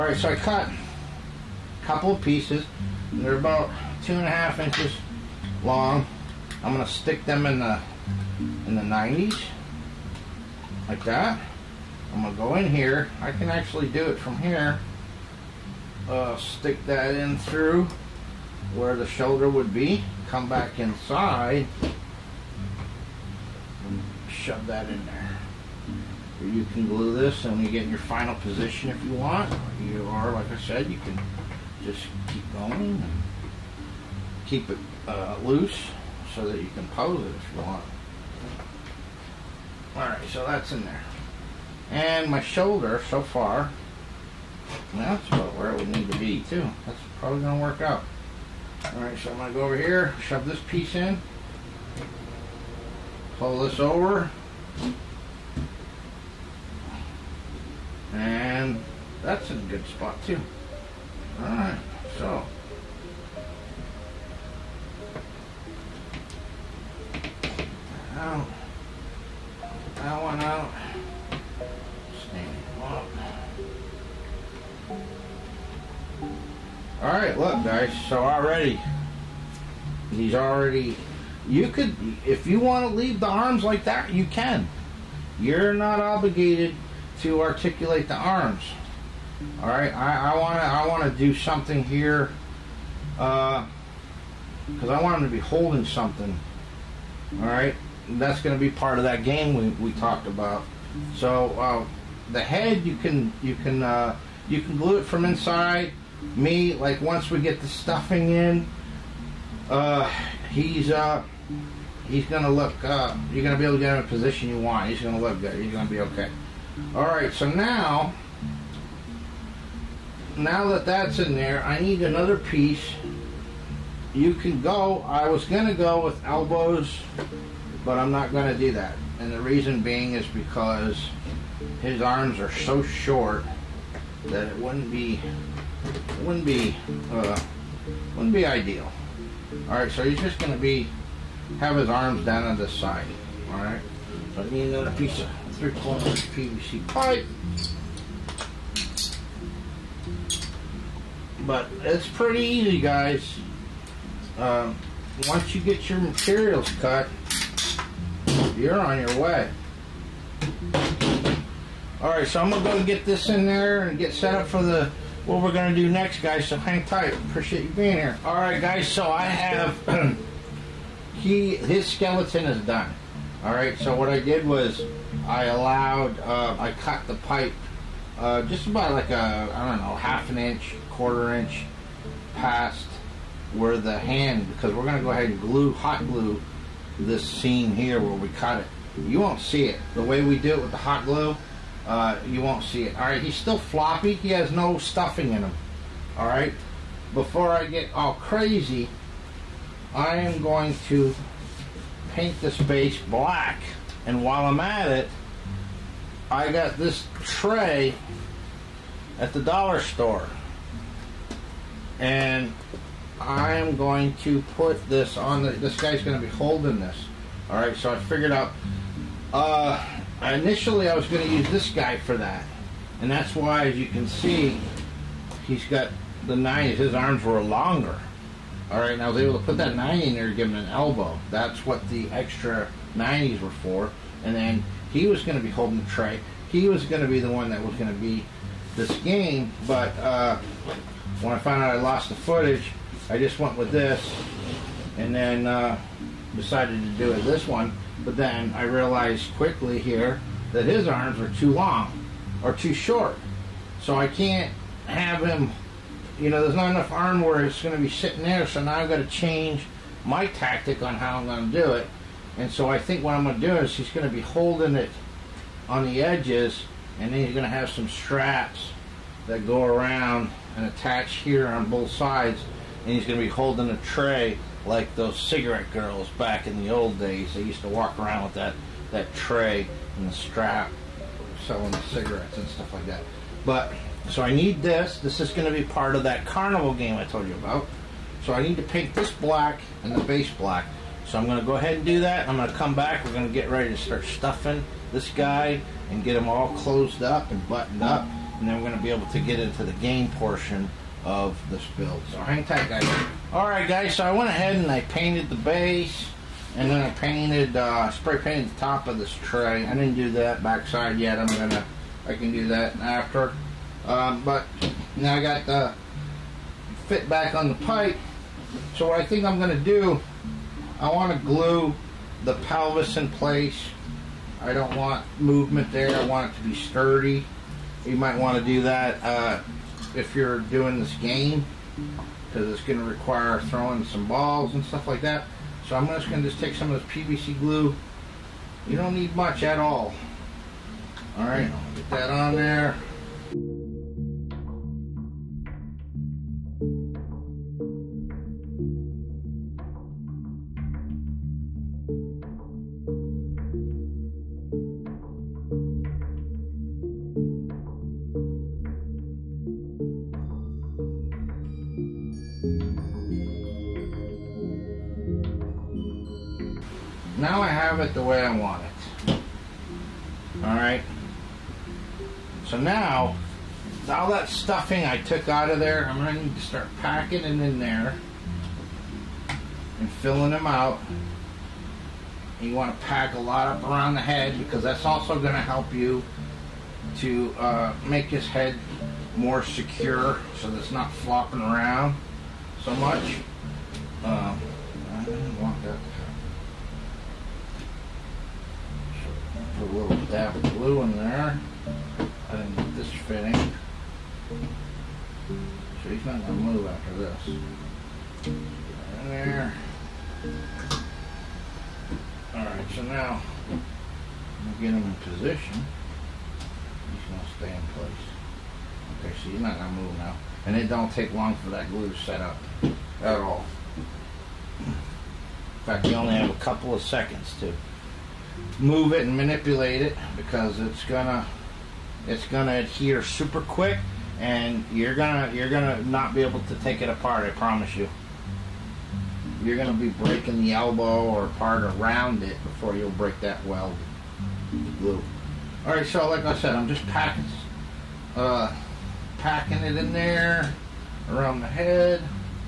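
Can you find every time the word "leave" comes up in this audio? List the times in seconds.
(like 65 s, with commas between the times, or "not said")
82 s.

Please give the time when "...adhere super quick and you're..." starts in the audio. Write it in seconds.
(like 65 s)
432 s.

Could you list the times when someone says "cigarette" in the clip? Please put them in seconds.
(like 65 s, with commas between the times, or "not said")
275 s, 281 s.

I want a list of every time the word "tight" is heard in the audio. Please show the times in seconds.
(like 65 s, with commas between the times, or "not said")
166 s, 302 s.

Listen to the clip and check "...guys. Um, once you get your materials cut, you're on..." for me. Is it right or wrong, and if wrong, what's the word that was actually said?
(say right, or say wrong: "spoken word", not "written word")
right.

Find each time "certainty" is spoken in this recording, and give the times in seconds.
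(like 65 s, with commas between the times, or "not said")
not said.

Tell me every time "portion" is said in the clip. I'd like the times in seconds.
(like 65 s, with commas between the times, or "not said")
300 s.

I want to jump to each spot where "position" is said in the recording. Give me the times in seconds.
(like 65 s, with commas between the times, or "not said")
28 s, 114 s.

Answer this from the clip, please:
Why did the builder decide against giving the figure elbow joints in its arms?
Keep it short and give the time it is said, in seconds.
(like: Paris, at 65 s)
arms are so short, at 131 s.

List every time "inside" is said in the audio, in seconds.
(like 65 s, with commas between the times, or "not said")
20 s, 105 s.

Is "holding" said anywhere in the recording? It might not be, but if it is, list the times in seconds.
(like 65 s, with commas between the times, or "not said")
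95 s, 216 s, 235 s, 264 s, 273 s.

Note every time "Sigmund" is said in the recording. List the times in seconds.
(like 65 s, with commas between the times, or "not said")
not said.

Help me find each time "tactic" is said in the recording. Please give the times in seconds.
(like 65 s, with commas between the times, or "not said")
260 s.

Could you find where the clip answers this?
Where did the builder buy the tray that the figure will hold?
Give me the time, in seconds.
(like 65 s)
209 s.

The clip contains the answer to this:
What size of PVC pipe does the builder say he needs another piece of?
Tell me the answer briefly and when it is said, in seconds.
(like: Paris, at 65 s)
three quarter, at 145 s.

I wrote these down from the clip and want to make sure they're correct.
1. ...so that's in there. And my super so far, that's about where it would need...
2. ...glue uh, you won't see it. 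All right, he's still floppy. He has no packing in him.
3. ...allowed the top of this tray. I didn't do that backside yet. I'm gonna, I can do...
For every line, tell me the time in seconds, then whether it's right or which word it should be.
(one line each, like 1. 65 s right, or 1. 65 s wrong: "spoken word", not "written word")
1. 40 s wrong: "shoulder", not "super"
2. 191 s wrong: "stuffing", not "packing"
3. 308 s wrong: "painted", not "allowed".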